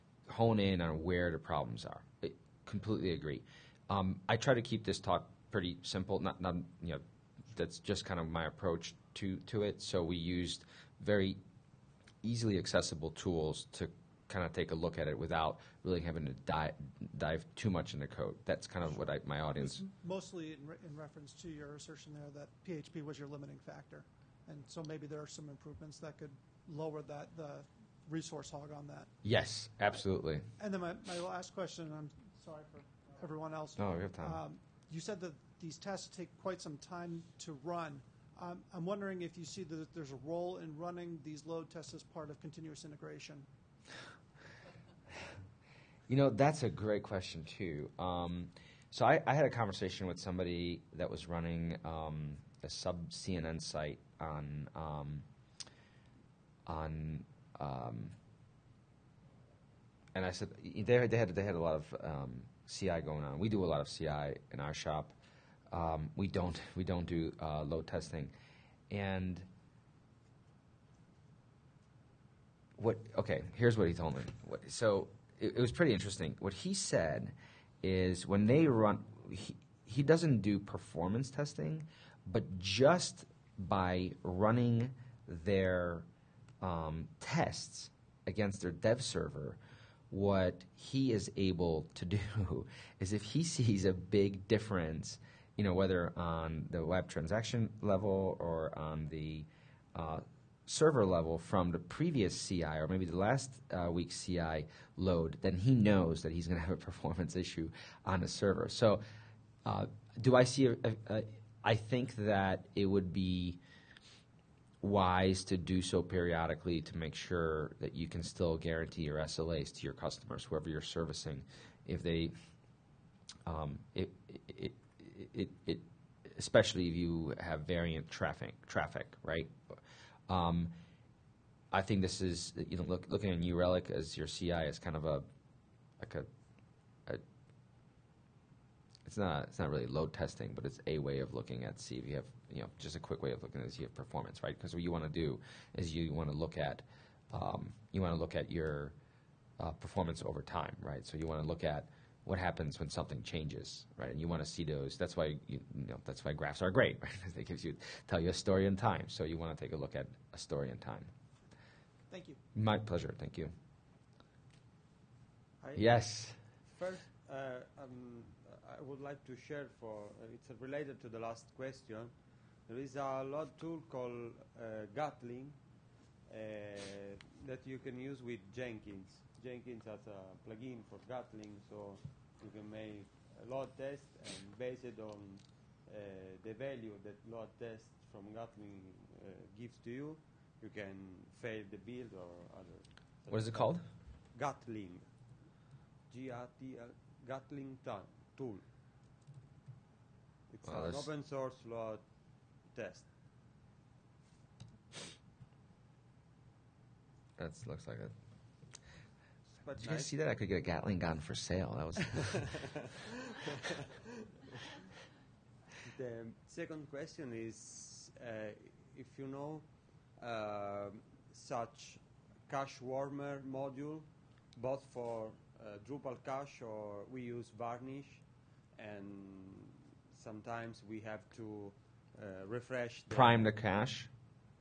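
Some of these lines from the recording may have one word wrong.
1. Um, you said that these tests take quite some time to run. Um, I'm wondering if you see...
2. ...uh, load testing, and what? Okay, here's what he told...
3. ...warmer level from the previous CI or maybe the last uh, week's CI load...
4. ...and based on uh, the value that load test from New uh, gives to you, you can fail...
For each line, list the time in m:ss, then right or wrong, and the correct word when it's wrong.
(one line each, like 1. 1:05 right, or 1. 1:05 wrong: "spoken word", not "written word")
1. 0:34 right
2. 1:07 right
3. 1:40 wrong: "server", not "warmer"
4. 3:04 wrong: "Gatling", not "New".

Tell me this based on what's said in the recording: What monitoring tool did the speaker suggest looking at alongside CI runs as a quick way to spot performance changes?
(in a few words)
New Relic.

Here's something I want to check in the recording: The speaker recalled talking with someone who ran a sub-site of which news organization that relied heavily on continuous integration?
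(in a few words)
CNN.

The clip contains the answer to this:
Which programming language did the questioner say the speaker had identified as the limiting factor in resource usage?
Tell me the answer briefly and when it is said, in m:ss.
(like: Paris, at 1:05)
PHP, at 0:22.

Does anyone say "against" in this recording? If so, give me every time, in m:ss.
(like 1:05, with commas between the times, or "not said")
1:28.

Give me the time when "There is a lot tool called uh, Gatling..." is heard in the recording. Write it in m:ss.
2:52.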